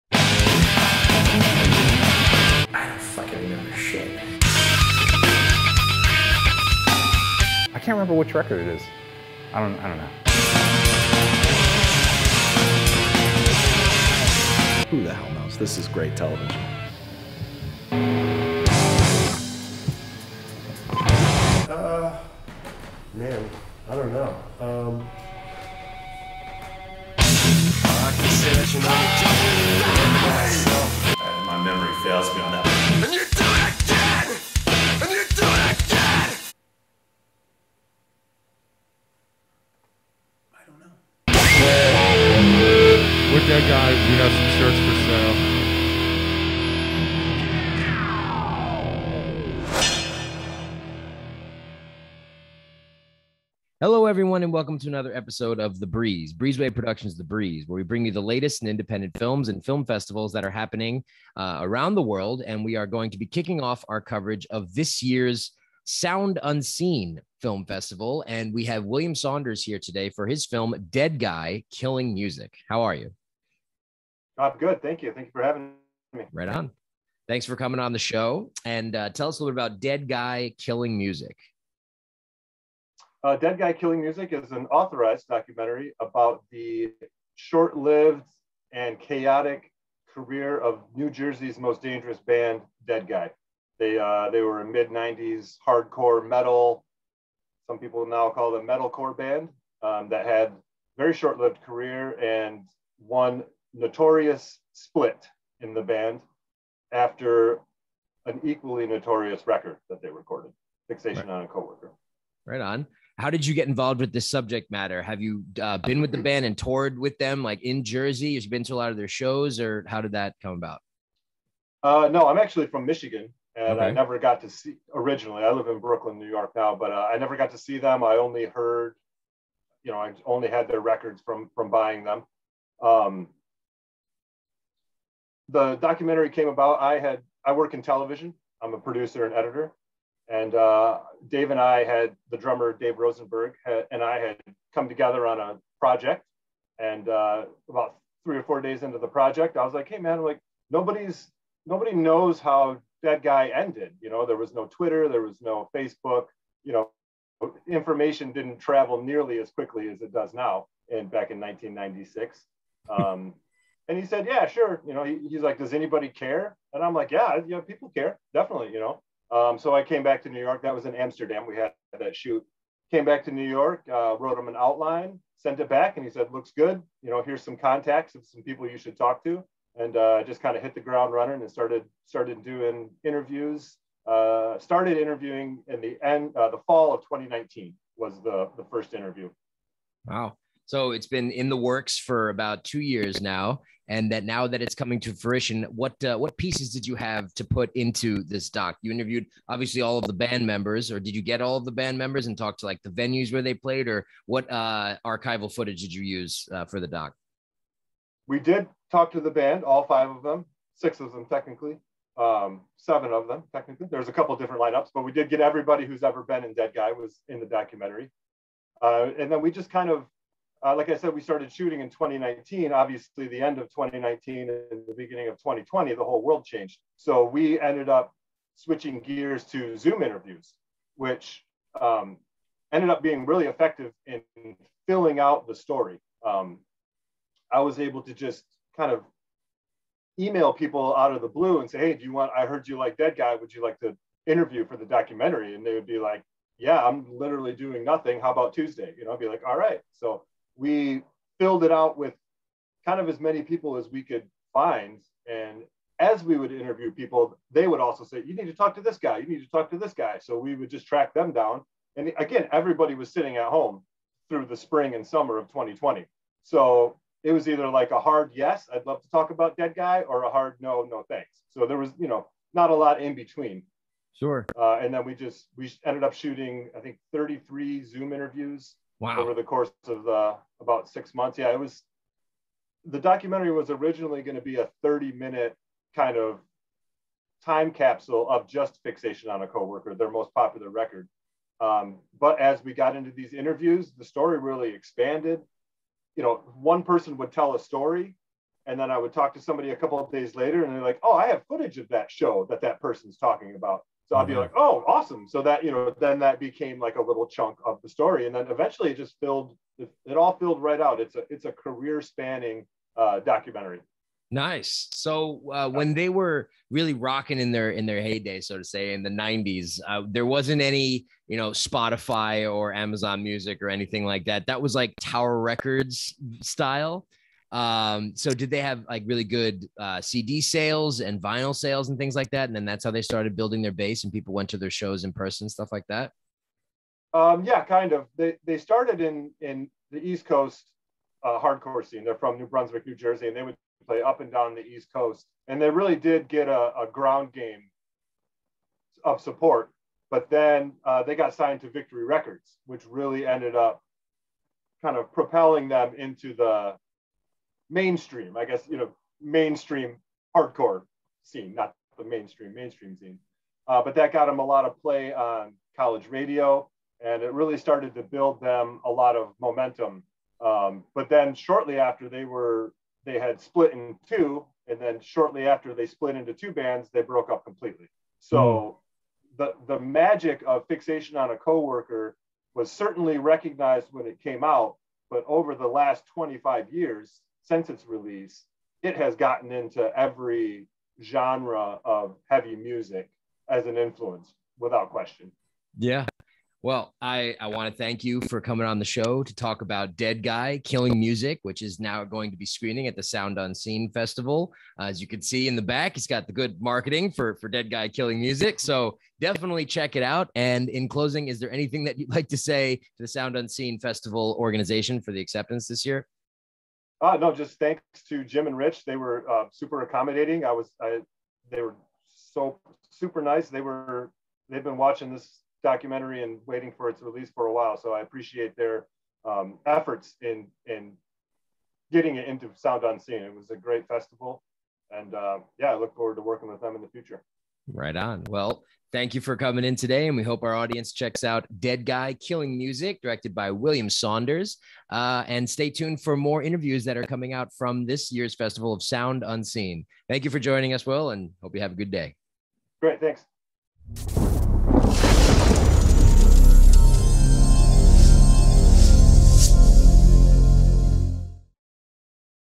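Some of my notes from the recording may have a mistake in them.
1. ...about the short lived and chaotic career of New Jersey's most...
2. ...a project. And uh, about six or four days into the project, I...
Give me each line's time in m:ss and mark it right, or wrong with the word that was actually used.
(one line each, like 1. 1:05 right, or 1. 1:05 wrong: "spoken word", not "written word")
1. 1:25 right
2. 2:25 wrong: "three", not "six".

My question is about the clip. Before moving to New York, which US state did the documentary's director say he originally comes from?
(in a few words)
Michigan.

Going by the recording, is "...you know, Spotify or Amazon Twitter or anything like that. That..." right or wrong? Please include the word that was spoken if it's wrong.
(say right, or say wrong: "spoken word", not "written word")
wrong: "Music", not "Twitter".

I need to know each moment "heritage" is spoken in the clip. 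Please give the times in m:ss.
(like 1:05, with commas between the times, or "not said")
not said.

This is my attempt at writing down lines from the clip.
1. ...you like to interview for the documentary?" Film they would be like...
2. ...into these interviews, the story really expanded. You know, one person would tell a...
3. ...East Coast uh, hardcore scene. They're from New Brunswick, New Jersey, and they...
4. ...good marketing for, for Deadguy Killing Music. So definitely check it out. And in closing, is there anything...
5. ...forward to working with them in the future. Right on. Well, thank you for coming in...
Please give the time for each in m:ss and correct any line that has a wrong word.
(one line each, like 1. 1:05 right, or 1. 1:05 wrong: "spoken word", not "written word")
1. 4:03 wrong: "And", not "Film"
2. 4:52 right
3. 5:40 right
4. 6:46 right
5. 7:15 right.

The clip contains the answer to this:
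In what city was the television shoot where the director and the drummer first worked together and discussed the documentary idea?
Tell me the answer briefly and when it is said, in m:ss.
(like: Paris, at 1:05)
Amsterdam, at 2:50.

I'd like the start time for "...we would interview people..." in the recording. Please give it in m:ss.
4:16.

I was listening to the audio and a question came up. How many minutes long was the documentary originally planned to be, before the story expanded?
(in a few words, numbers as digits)
30 minutes.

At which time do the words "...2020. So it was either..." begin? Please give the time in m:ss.
4:25.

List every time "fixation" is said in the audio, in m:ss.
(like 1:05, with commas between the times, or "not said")
1:50, 4:48, 6:20.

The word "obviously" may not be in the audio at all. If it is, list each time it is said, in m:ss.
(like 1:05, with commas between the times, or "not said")
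3:19, 3:42.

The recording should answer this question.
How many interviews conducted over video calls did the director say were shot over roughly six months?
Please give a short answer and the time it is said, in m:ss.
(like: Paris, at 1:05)
33, at 4:37.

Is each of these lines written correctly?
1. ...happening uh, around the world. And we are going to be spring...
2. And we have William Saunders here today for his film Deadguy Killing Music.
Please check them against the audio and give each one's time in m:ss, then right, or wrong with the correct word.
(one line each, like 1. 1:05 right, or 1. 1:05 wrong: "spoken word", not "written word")
1. 1:00 wrong: "kicking", not "spring"
2. 1:08 right.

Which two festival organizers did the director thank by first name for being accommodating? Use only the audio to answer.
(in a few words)
Jim and Rich.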